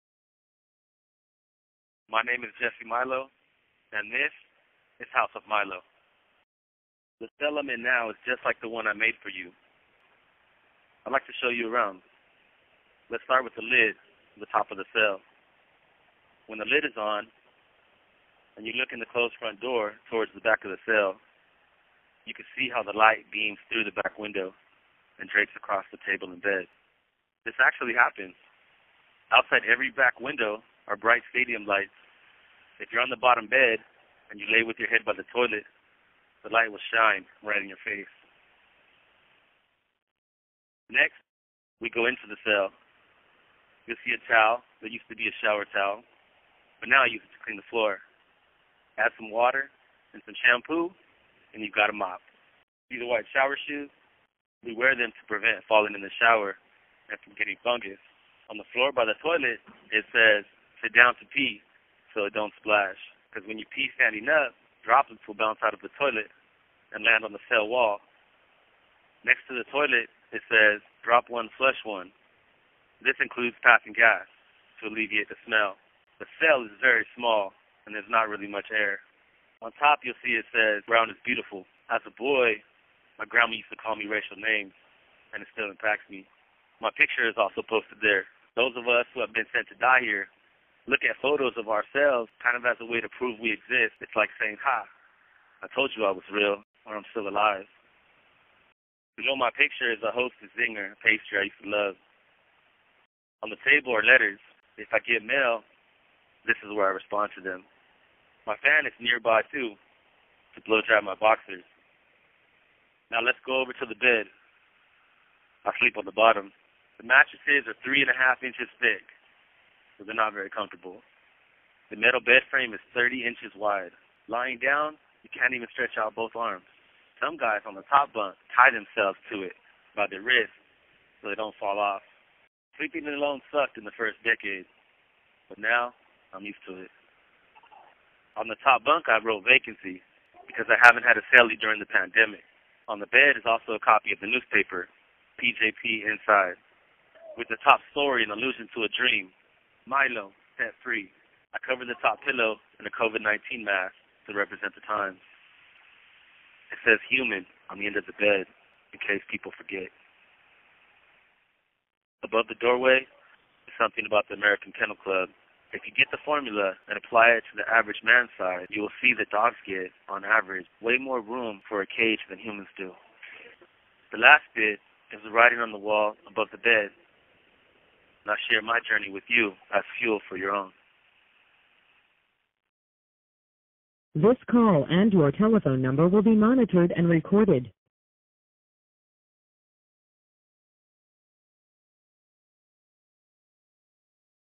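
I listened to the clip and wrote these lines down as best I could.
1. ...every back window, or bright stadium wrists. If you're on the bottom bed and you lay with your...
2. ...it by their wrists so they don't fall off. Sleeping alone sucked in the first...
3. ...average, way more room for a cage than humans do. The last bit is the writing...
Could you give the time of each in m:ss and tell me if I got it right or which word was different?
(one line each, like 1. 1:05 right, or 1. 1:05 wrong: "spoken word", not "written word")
1. 0:29 wrong: "lights", not "wrists"
2. 2:09 right
3. 2:50 right.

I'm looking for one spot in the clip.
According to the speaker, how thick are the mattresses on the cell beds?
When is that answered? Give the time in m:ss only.
1:57.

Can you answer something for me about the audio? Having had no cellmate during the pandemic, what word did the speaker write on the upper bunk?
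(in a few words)
vacancy.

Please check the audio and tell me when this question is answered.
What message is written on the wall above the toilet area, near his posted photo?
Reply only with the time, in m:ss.
1:20.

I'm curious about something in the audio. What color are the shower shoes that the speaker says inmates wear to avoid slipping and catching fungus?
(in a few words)
white.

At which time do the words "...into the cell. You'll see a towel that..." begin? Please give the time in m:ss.
0:42.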